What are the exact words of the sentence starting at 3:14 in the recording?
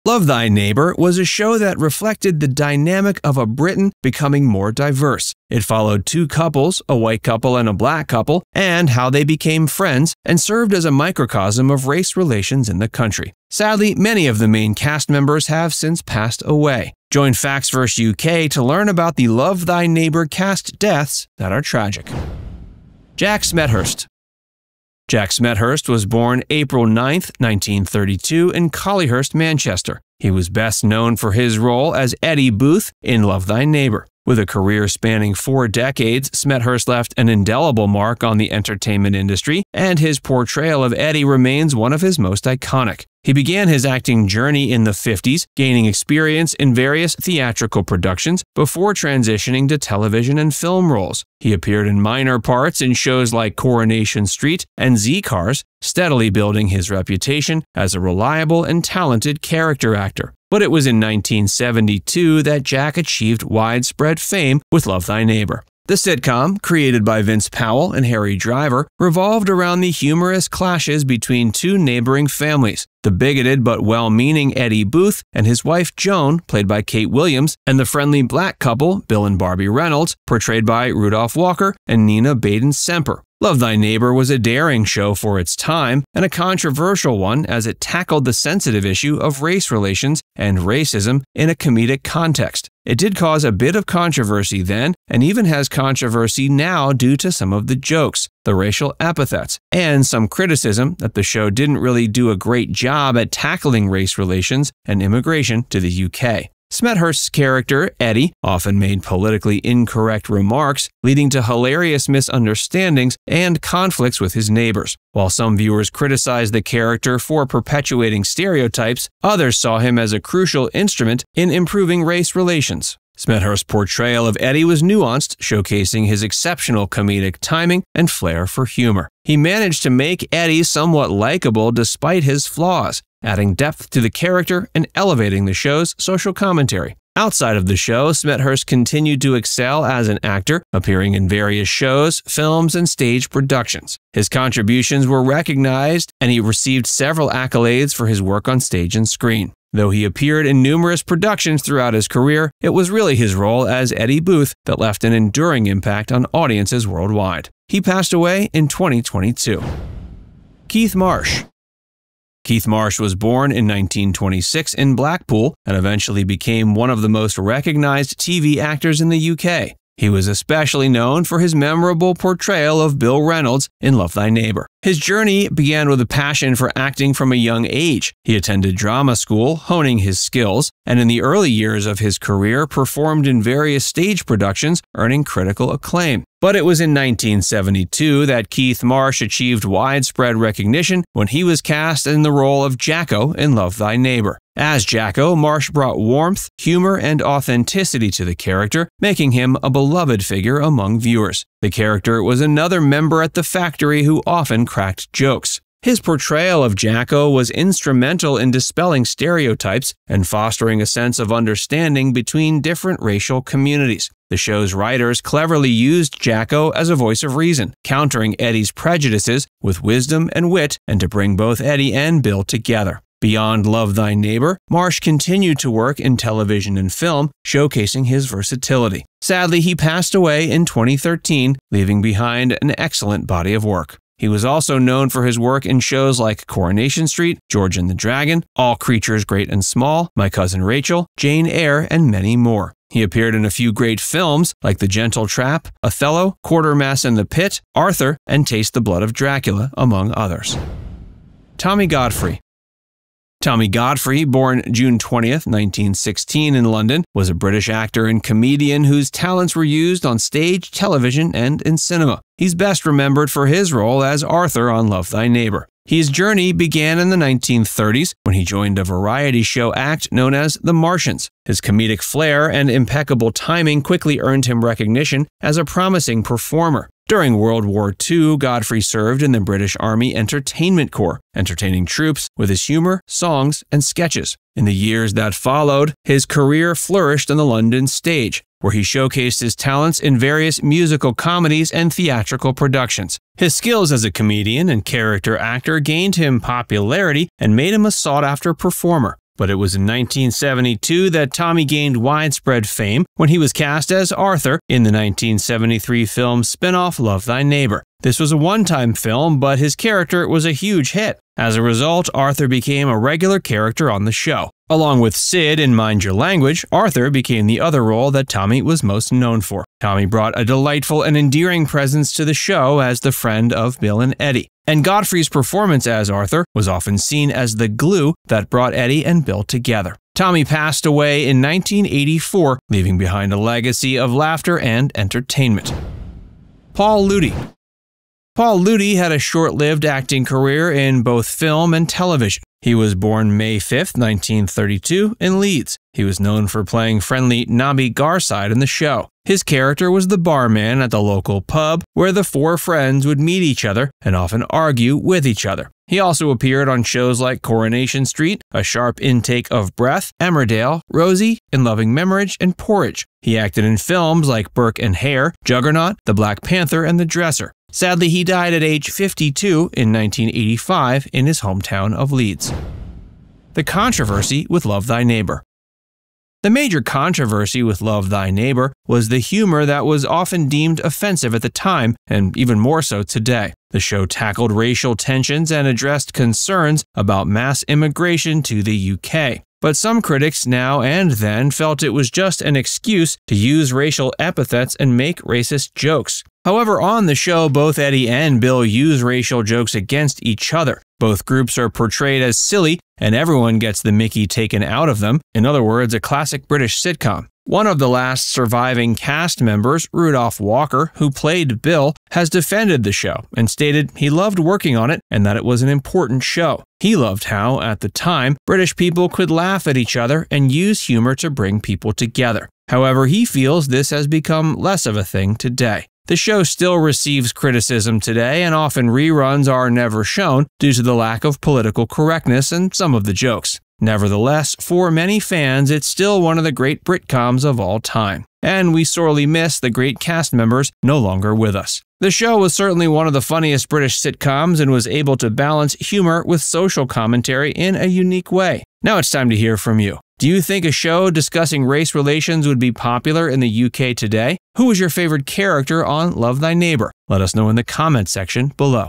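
As Jacko, Marsh brought warmth, humor, and authenticity to the character, making him a beloved figure among viewers.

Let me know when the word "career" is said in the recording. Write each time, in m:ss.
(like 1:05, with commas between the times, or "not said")
0:34, 2:32, 3:02, 4:46, 5:40.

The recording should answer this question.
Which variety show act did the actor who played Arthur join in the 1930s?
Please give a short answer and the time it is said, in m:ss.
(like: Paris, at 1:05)
The Martians, at 4:30.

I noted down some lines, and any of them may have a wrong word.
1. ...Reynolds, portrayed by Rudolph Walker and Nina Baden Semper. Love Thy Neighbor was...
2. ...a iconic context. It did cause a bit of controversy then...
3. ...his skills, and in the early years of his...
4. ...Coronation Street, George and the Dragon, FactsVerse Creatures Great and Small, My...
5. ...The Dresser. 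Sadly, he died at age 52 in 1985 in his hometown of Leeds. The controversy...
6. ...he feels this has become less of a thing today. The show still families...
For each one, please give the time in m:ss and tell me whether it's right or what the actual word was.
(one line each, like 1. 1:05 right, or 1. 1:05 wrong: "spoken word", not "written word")
1. 1:19 right
2. 1:31 wrong: "comedic", not "iconic"
3. 2:59 right
4. 3:56 wrong: "All", not "FactsVerse"
5. 6:06 right
6. 7:03 wrong: "receives", not "families".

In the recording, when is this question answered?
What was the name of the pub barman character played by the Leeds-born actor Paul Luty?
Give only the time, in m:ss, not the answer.
5:47.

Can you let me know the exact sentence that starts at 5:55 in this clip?
He also appeared on shows like Coronation Street, A Sharp Intake of Breath, Emmerdale, Rosie, In Loving Memory, and Porridge.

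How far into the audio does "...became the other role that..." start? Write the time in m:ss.
5:17.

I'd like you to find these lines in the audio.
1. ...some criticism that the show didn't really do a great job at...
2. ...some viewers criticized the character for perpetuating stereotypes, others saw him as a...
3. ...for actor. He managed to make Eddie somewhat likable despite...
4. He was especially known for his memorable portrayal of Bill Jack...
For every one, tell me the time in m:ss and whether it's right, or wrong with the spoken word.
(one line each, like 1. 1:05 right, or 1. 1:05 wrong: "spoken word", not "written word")
1. 1:40 right
2. 1:55 right
3. 2:08 wrong: "humor", not "actor"
4. 2:50 wrong: "Reynolds", not "Jack".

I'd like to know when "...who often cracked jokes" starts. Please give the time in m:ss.
3:24.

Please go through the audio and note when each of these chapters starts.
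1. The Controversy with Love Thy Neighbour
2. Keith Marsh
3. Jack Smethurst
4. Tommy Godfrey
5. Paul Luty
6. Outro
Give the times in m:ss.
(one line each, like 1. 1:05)
1. 6:13
2. 2:40
3. 0:23
4. 4:11
5. 5:36
6. 7:28.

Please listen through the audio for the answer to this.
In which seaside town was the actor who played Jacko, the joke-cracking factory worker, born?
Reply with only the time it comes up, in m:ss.
2:44.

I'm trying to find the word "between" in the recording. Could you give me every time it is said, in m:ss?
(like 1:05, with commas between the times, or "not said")
1:11, 3:32.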